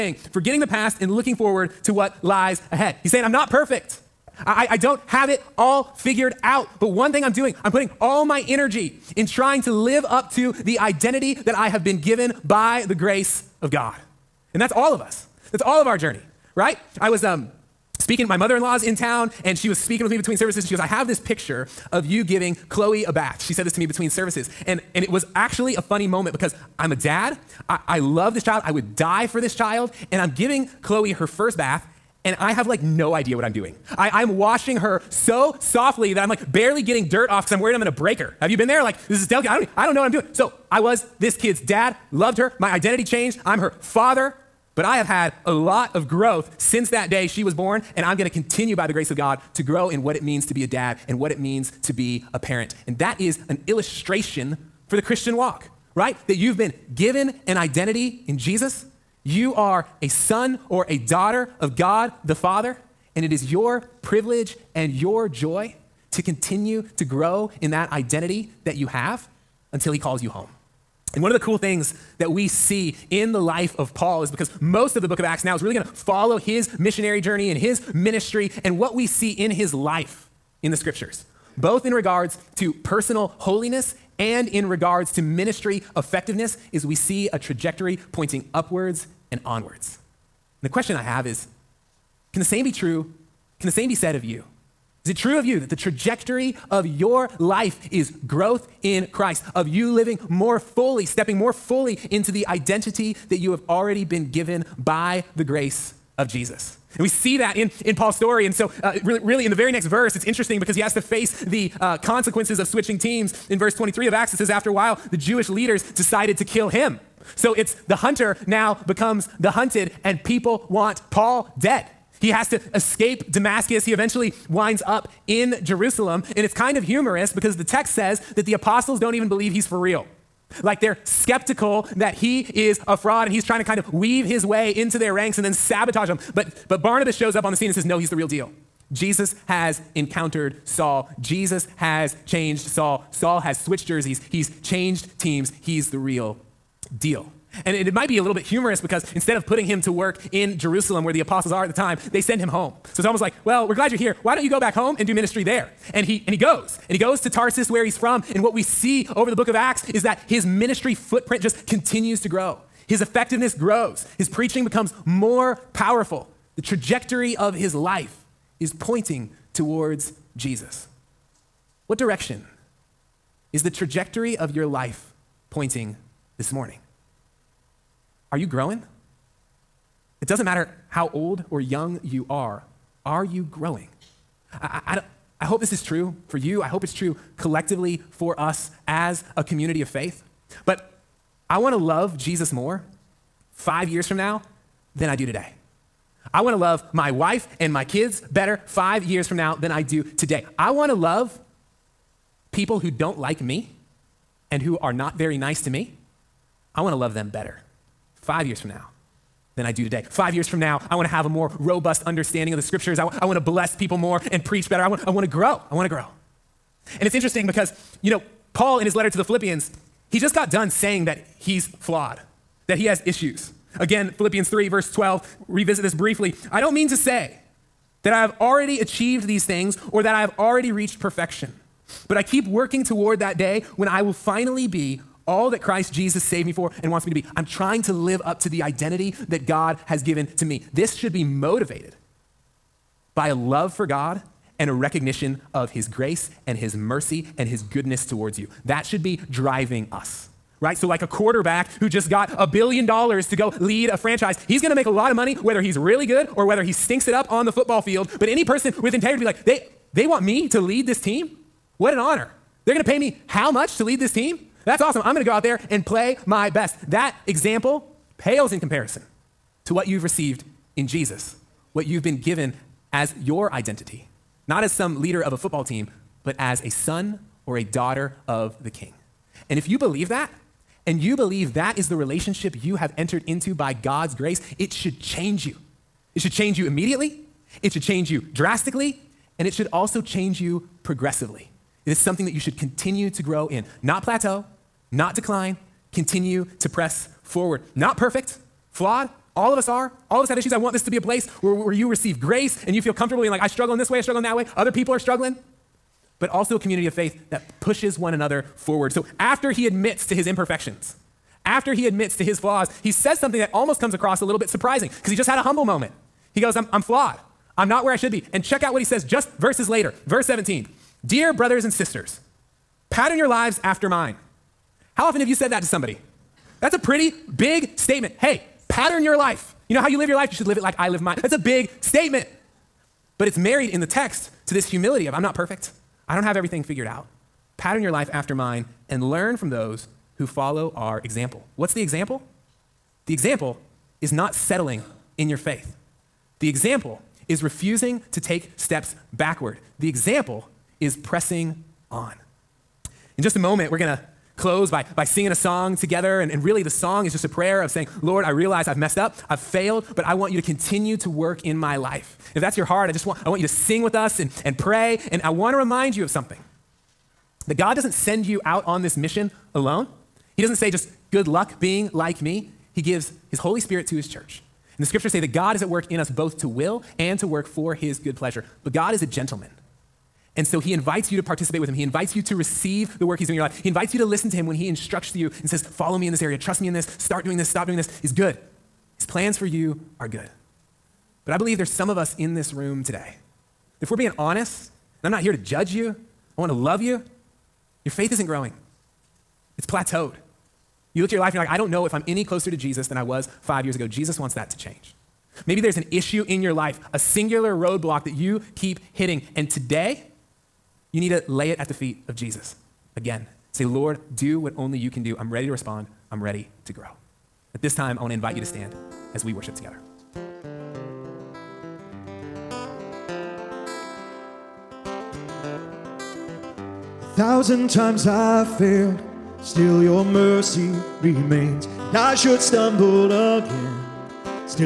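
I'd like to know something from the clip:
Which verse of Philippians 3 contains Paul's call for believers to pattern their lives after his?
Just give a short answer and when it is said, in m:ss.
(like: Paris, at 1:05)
Verse 17, at 5:20.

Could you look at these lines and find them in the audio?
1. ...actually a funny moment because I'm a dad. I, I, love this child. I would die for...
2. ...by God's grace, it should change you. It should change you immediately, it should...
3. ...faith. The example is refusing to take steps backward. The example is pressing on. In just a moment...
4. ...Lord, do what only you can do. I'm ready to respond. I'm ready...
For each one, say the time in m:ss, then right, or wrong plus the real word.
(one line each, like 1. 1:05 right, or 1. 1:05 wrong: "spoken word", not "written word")
1. 0:25 right
2. 4:43 right
3. 5:45 right
4. 6:53 right.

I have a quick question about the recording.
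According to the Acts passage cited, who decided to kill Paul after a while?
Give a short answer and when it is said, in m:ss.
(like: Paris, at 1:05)
The Jewish leaders, at 1:55.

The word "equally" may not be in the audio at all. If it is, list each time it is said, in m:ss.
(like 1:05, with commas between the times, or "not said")
not said.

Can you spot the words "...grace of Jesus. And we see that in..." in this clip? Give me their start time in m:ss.
1:45.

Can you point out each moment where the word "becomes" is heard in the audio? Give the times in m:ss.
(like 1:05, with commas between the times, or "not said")
1:58, 2:44.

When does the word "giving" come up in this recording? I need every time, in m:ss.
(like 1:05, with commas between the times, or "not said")
0:22, 0:30.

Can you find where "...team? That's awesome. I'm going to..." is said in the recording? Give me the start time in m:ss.
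4:24.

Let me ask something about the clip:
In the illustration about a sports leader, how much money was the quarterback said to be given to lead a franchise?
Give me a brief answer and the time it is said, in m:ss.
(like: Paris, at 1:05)
a billion dollars, at 4:12.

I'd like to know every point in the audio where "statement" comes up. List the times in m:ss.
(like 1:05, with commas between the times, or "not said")
5:27, 5:31.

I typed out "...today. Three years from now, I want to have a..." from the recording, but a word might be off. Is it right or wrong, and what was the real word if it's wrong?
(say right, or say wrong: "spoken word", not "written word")
wrong: "Five", not "Three".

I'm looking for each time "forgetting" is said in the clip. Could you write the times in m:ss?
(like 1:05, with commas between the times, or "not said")
0:00.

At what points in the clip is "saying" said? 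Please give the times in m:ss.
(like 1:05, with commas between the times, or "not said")
0:03, 3:40, 5:57.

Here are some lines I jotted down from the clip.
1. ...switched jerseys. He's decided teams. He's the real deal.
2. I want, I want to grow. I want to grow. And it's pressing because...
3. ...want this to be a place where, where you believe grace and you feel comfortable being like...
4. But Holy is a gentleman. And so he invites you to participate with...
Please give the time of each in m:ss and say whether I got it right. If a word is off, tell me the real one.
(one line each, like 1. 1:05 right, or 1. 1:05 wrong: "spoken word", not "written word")
1. 2:23 wrong: "changed", not "decided"
2. 3:34 wrong: "interesting", not "pressing"
3. 5:00 wrong: "receive", not "believe"
4. 6:18 wrong: "God", not "Holy".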